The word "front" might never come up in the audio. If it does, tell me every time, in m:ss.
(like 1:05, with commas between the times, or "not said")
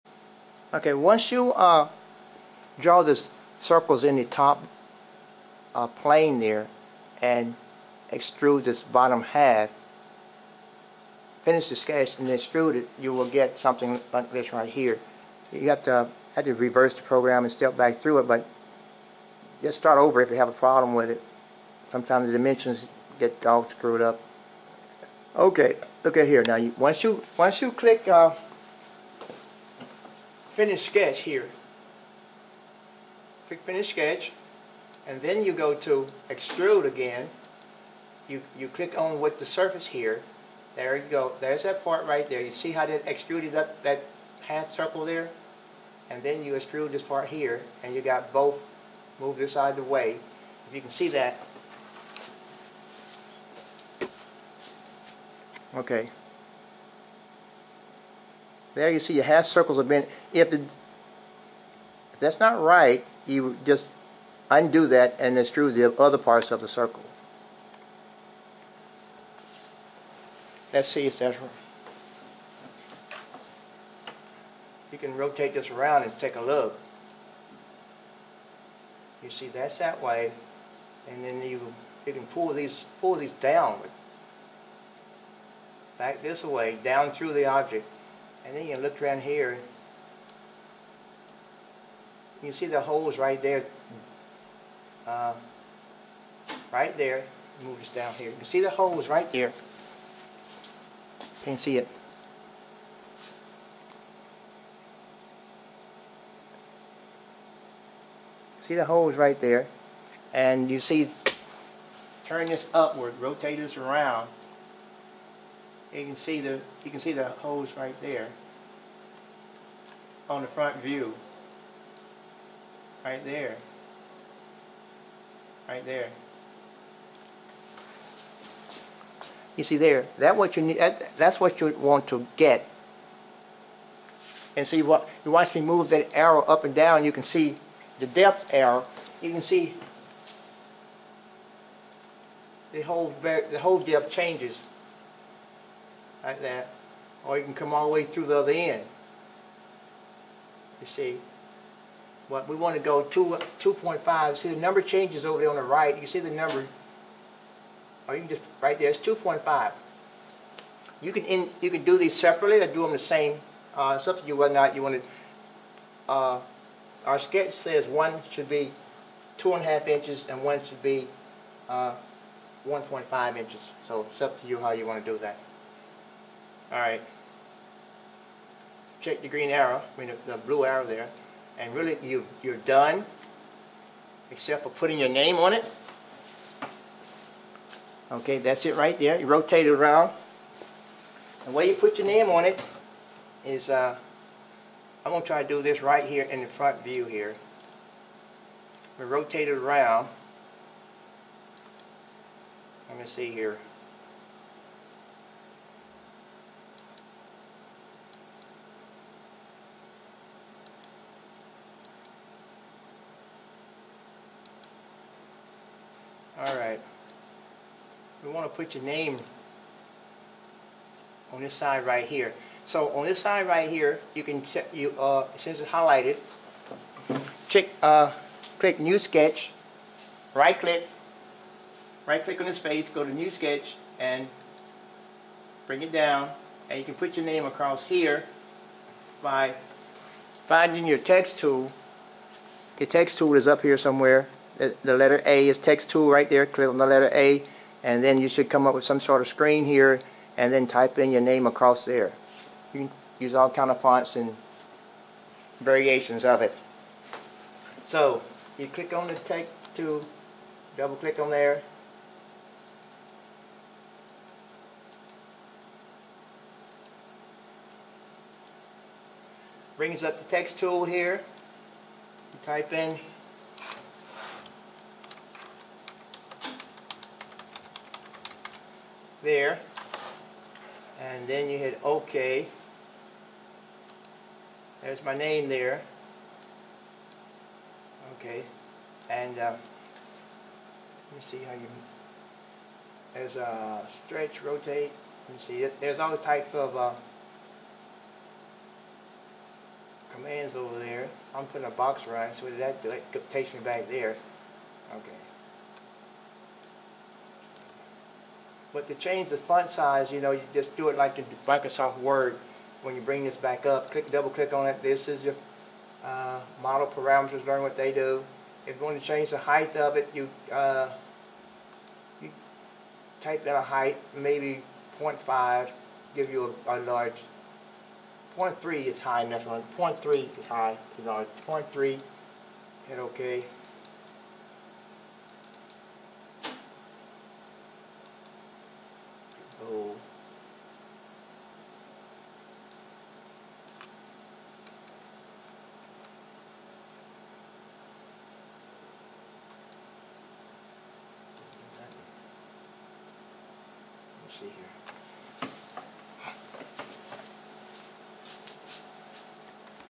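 2:00, 3:16.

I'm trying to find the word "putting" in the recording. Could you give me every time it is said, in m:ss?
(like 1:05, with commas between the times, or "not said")
3:04, 5:01.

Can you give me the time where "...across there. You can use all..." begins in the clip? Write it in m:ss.
4:11.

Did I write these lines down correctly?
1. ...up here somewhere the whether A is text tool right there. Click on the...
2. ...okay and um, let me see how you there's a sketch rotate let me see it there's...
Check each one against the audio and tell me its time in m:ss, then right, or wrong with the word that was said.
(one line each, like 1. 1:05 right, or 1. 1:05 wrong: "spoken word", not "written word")
1. 4:03 wrong: "letter", not "whether"
2. 4:48 wrong: "stretch", not "sketch".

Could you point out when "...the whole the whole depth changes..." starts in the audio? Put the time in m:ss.
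2:22.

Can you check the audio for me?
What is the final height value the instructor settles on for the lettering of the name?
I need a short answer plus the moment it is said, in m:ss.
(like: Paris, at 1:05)
0.3, at 5:28.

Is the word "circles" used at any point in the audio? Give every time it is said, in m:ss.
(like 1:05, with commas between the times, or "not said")
0:03, 0:44, 0:59, 1:06.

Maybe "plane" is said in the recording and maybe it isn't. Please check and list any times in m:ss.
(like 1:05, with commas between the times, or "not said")
0:05.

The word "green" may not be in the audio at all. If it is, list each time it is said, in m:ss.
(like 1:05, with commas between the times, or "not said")
2:59.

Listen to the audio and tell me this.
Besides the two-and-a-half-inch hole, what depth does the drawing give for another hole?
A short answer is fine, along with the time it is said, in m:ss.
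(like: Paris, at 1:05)
1.5 inches, at 2:52.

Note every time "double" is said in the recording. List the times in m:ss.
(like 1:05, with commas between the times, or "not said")
4:20, 5:14.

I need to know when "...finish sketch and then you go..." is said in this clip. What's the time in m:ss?
0:33.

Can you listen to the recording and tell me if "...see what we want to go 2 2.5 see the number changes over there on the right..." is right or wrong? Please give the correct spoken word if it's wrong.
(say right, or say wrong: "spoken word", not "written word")
right.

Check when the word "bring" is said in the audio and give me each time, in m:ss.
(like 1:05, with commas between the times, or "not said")
3:55, 4:29, 5:13.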